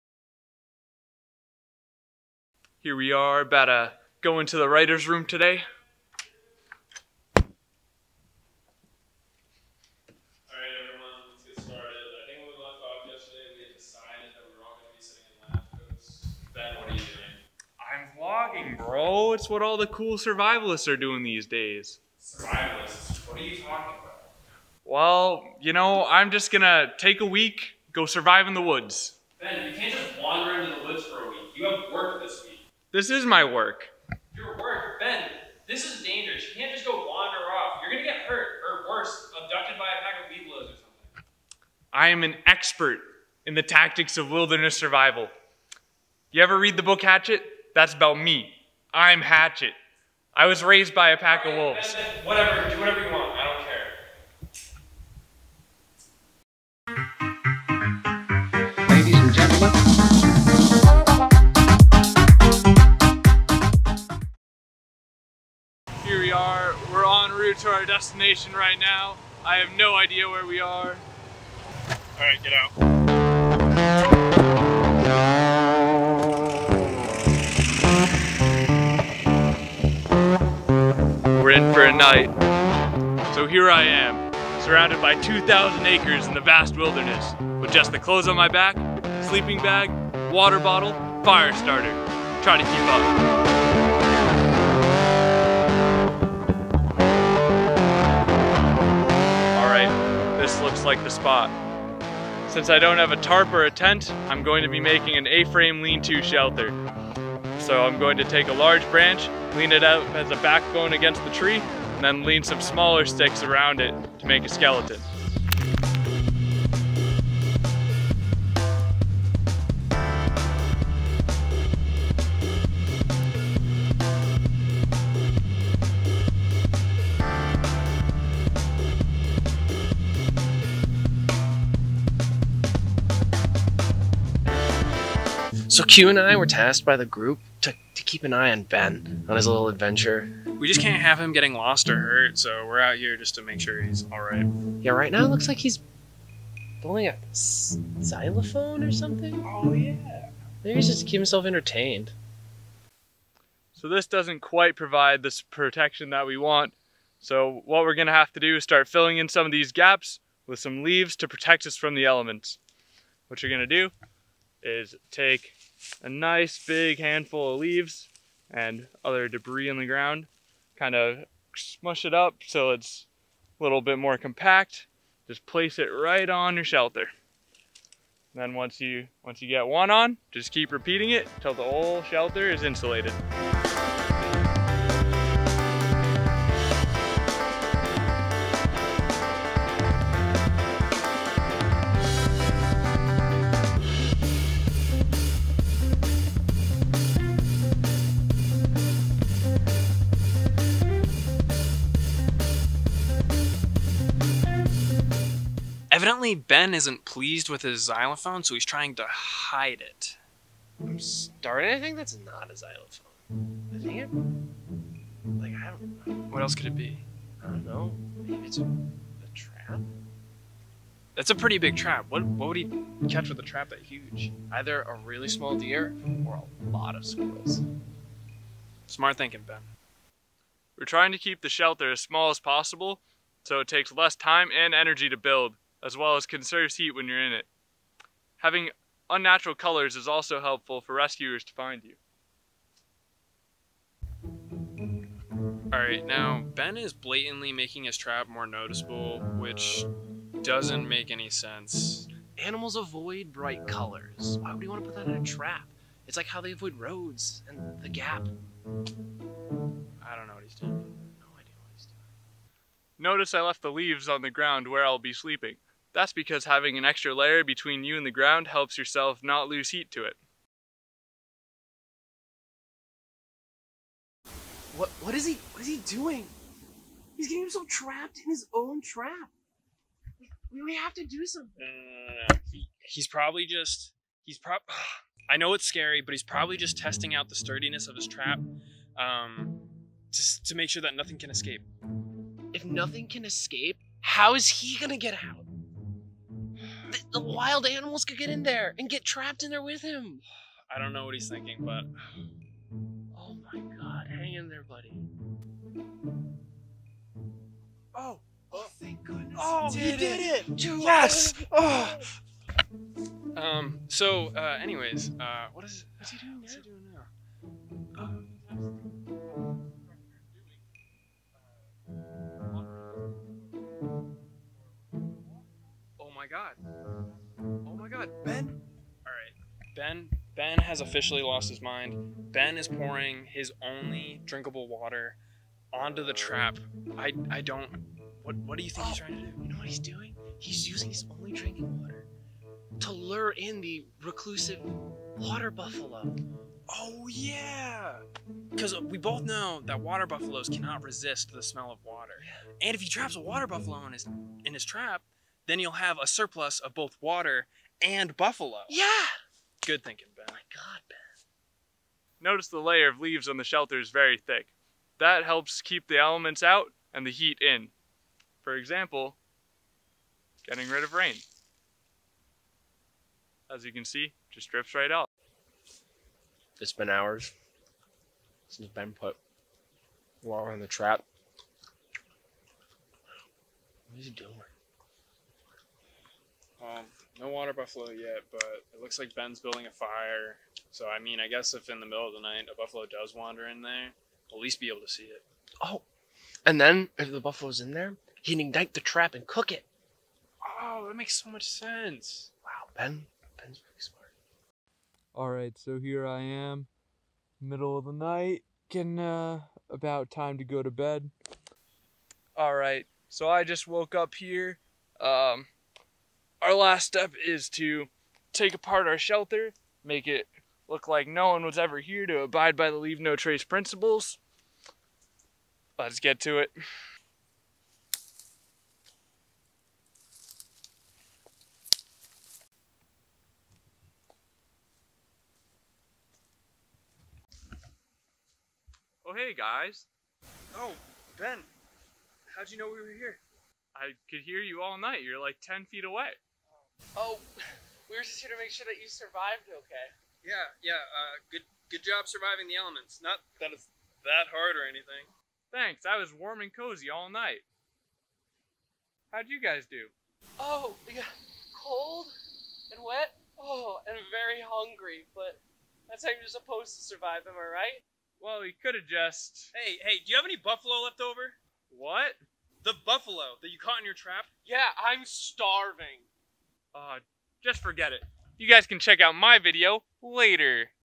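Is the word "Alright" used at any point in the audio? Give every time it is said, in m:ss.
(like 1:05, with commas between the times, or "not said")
4:05.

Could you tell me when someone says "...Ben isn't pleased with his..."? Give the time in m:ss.
3:26.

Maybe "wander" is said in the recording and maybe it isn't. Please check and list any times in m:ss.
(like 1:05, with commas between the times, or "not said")
0:30, 0:36, 6:33.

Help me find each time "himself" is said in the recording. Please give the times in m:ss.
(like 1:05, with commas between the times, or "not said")
2:31, 4:37.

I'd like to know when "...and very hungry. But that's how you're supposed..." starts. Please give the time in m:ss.
7:43.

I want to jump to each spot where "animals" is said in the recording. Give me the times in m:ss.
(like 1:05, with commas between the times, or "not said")
4:12, 4:57.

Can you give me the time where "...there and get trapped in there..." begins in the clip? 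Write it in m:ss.
4:58.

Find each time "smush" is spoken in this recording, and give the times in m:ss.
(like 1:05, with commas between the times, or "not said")
2:51.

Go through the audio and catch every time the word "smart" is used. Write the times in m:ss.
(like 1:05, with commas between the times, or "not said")
3:48, 6:43.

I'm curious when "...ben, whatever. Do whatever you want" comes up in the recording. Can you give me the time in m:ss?
0:52.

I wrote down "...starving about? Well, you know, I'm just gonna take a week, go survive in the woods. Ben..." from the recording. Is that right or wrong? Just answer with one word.
wrong.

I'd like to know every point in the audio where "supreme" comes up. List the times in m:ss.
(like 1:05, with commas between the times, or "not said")
not said.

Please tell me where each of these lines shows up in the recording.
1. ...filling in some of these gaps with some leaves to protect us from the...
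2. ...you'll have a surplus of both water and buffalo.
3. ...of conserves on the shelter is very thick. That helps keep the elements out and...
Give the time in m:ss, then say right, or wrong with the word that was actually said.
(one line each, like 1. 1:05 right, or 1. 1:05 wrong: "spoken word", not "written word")
1. 2:38 right
2. 5:55 right
3. 6:02 wrong: "leaves", not "conserves".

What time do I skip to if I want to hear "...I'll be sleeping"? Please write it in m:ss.
4:24.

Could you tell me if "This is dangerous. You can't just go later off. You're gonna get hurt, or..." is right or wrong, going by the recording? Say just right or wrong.
wrong.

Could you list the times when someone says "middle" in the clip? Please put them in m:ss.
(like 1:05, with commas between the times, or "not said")
6:31, 6:47.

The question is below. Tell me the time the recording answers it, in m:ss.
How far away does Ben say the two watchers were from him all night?
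7:25.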